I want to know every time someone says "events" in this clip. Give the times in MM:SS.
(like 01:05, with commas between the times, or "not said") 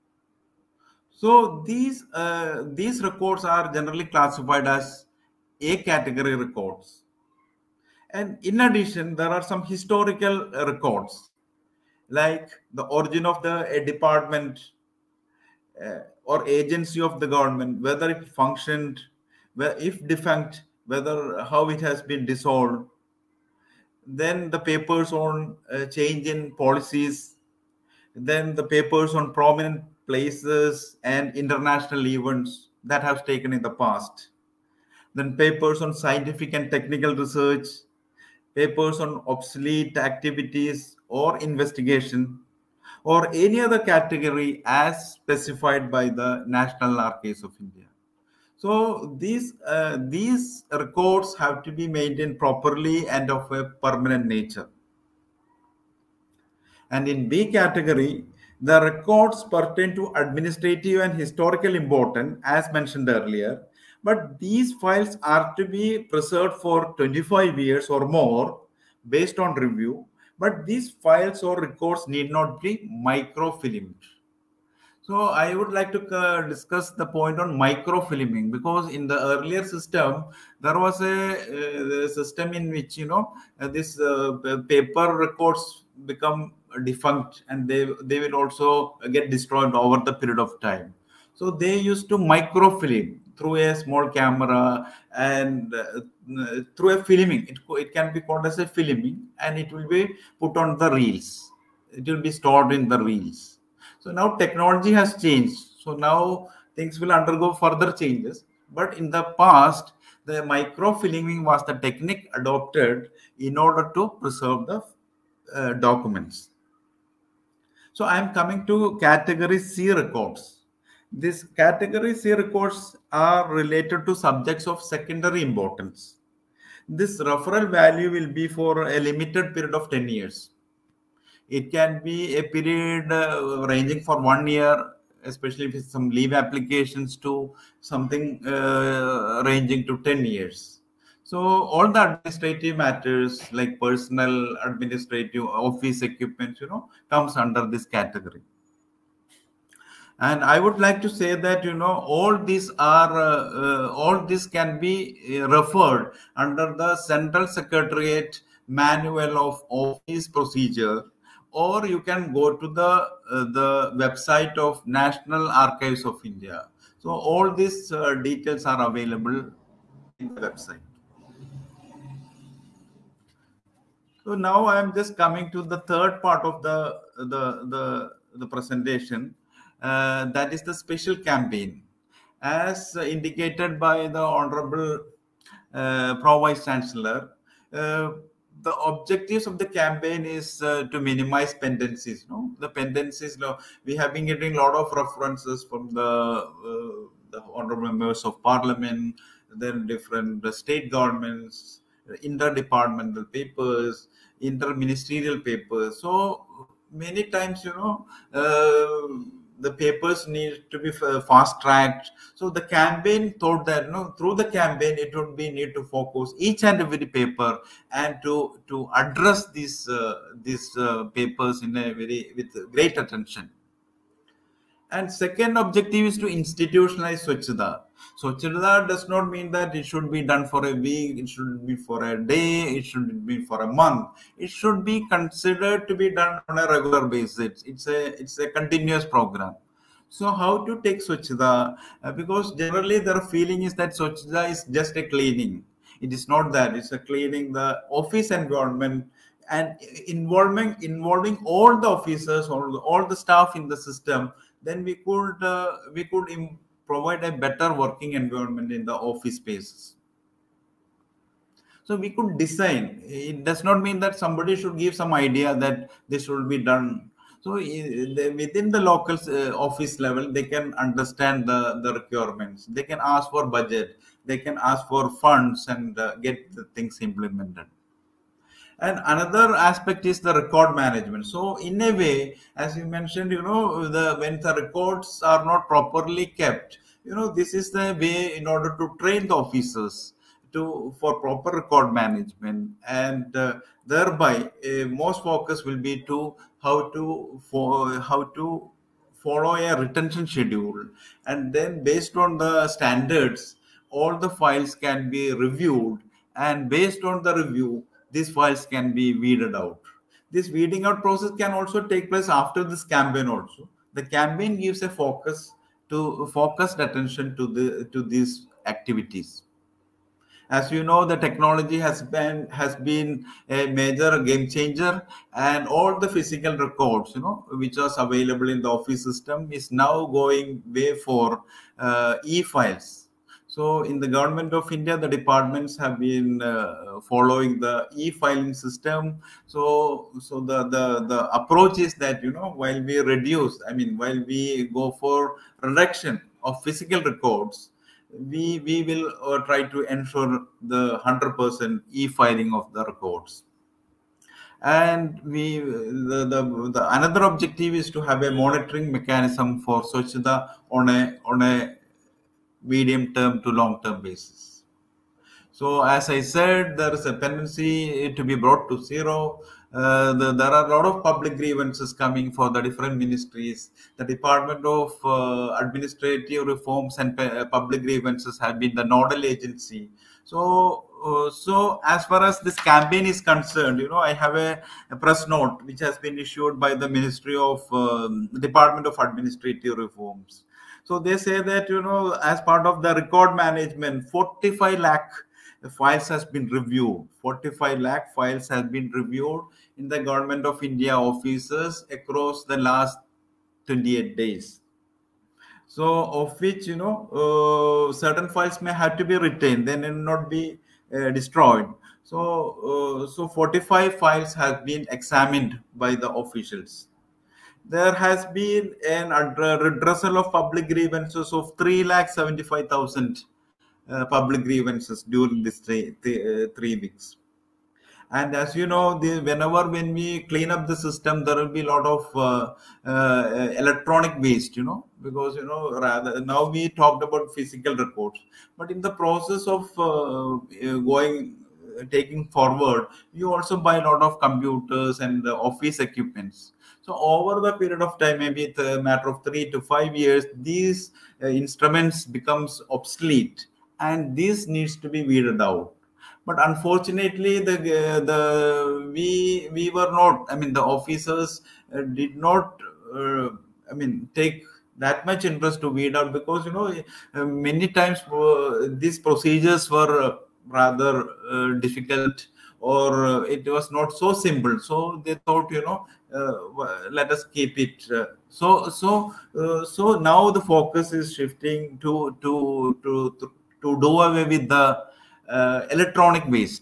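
00:32.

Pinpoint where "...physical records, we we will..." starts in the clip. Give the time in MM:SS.
05:46.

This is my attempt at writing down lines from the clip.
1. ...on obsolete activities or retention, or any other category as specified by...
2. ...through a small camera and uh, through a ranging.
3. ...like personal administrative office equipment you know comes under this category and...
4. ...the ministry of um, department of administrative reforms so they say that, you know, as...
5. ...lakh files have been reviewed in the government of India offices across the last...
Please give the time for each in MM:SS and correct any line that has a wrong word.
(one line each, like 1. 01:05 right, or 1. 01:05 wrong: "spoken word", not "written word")
1. 00:38 wrong: "investigation", not "retention"
2. 01:33 wrong: "filming", not "ranging"
3. 02:23 right
4. 06:26 right
5. 06:37 right.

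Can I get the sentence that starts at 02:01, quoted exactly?
These category C records are related to subjects of secondary importance.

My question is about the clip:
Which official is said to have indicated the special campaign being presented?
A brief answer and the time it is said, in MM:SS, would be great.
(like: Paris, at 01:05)
Pro Vice Chancellor, at 03:06.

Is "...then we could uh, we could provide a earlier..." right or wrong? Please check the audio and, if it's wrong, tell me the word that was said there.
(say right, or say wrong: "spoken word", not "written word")
wrong: "better", not "earlier".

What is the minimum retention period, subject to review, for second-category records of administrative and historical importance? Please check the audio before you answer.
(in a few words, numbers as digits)
25 years.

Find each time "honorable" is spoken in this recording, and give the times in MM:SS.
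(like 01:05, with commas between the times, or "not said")
03:04, 03:17.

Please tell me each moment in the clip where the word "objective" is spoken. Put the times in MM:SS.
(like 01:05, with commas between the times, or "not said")
03:08, 03:45, 05:57.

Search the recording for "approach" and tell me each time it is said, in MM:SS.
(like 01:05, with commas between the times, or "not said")
05:41.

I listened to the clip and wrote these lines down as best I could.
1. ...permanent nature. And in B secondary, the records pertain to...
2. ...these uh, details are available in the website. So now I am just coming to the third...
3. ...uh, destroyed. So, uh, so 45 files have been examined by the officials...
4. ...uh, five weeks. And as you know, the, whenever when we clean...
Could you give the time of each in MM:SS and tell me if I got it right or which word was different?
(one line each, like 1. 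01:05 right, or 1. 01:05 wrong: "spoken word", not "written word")
1. 00:53 wrong: "category", not "secondary"
2. 02:47 right
3. 06:50 right
4. 07:06 wrong: "three", not "five".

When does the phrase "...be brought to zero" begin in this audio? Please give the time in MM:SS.
06:08.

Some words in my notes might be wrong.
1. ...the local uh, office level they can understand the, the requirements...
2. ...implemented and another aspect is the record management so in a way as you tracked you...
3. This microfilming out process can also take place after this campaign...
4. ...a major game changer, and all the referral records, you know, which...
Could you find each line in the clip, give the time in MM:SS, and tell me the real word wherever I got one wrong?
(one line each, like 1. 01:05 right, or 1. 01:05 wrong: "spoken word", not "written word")
1. 04:28 right
2. 04:37 wrong: "mentioned", not "tracked"
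3. 05:10 wrong: "weeding", not "microfilming"
4. 05:23 wrong: "physical", not "referral".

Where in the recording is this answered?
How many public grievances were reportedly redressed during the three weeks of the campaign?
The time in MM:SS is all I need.
07:01.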